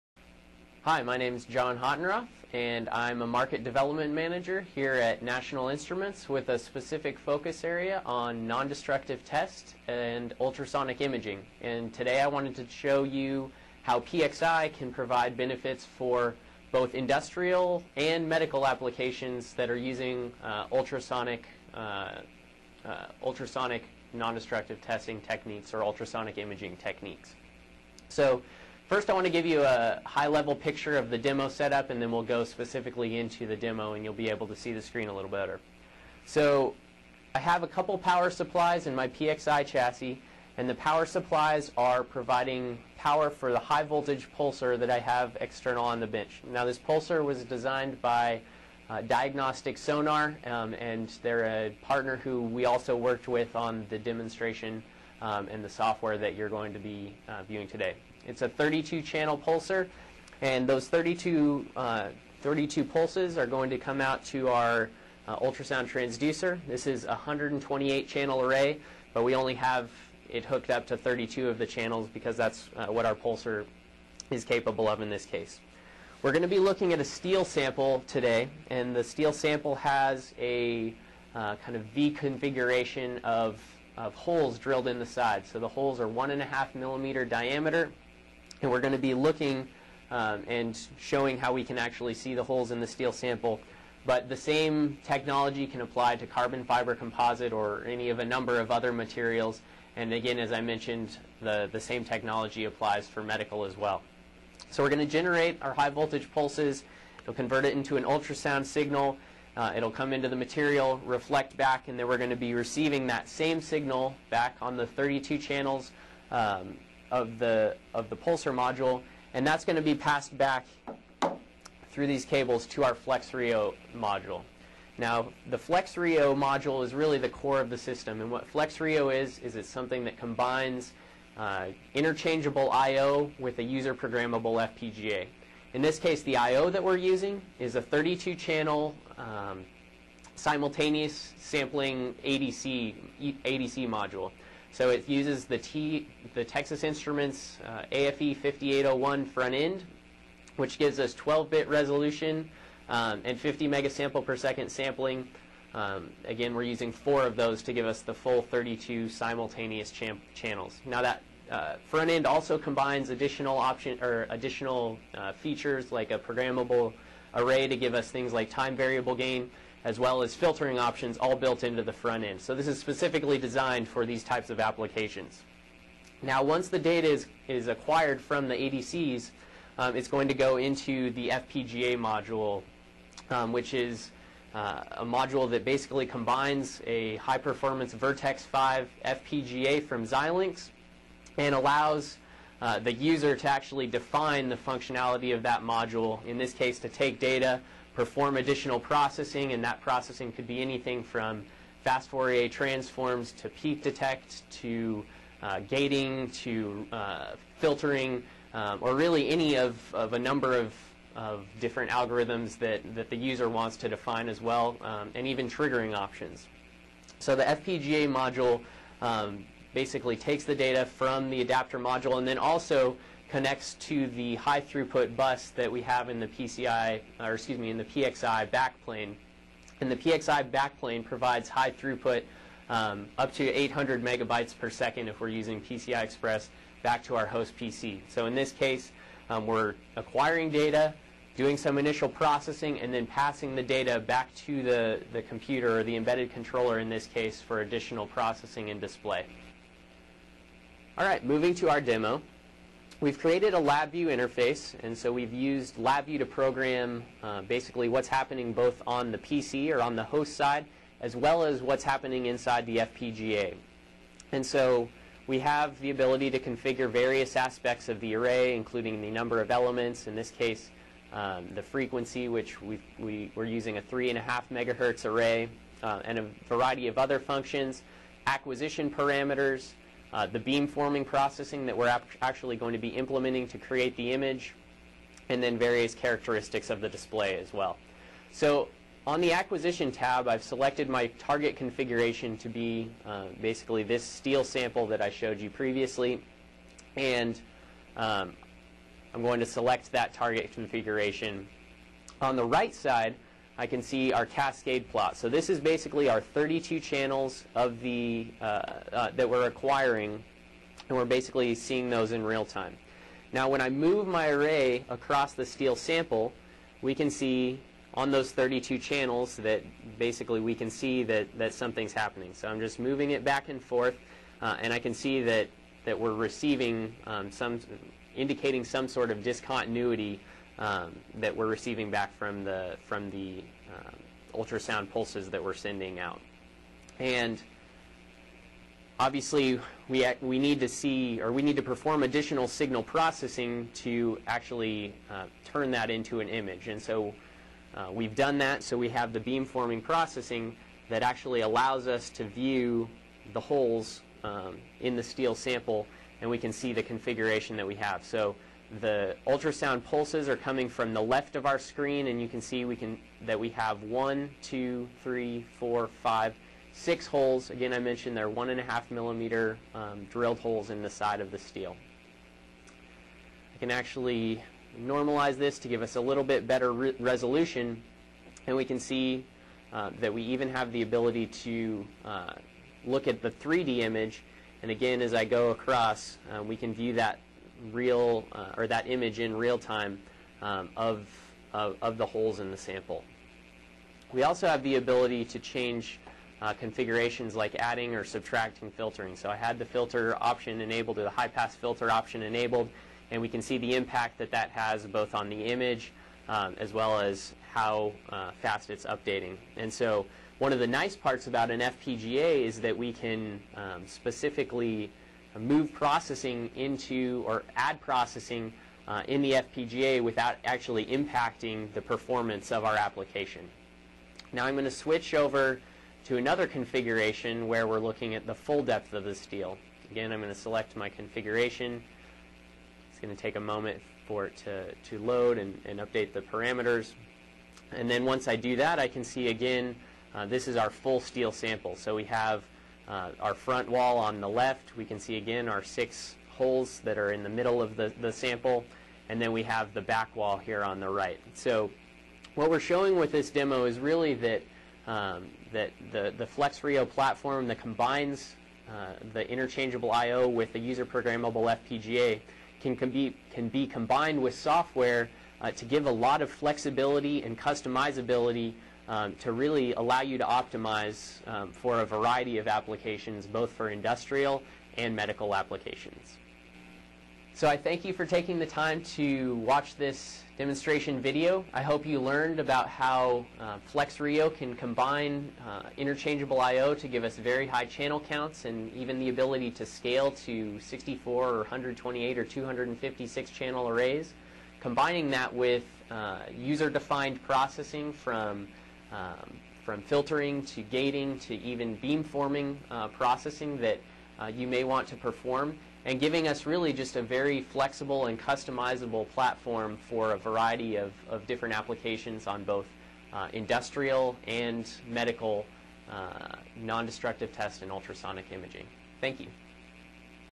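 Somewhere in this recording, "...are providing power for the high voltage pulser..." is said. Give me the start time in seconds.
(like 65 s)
41 s.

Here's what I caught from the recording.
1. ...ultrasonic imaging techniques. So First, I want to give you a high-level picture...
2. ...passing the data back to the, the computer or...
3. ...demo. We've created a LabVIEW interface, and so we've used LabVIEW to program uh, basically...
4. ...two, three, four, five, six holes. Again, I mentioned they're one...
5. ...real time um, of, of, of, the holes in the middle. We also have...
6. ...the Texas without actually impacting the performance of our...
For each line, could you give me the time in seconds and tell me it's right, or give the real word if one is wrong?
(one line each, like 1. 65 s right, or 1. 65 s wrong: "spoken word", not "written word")
1. 25 s right
2. 243 s right
3. 251 s right
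4. 364 s right
5. 389 s wrong: "sample", not "middle"
6. 419 s wrong: "FPGA", not "Texas".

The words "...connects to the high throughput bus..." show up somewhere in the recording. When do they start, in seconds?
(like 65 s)
223 s.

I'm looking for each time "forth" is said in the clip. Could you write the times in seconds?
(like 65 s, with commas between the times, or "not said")
323 s.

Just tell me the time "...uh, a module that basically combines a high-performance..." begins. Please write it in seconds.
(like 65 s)
184 s.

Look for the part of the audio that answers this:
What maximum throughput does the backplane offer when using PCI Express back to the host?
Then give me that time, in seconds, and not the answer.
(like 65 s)
233 s.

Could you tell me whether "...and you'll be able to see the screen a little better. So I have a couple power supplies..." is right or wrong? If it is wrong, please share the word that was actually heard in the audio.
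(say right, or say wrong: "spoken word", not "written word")
right.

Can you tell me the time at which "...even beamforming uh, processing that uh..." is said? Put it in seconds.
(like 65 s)
501 s.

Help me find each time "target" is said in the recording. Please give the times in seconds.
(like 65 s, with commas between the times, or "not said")
291 s, 300 s.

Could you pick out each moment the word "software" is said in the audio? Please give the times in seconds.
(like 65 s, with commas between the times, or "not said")
55 s, 464 s.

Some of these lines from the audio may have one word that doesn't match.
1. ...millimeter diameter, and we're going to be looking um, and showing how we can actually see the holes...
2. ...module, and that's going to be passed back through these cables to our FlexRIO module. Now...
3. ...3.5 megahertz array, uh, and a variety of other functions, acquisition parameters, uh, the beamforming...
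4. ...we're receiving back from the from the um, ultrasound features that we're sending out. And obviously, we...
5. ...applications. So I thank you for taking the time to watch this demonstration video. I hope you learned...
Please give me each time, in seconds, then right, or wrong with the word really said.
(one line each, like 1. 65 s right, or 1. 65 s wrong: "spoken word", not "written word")
1. 86 s right
2. 118 s right
3. 273 s right
4. 331 s wrong: "pulses", not "features"
5. 475 s right.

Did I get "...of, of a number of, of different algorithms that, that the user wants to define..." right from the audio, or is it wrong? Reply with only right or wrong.
right.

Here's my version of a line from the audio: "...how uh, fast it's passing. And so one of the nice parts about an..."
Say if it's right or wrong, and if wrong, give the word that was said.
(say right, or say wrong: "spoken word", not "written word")
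wrong: "updating", not "passing".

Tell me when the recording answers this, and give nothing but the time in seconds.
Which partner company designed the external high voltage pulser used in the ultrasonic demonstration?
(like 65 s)
49 s.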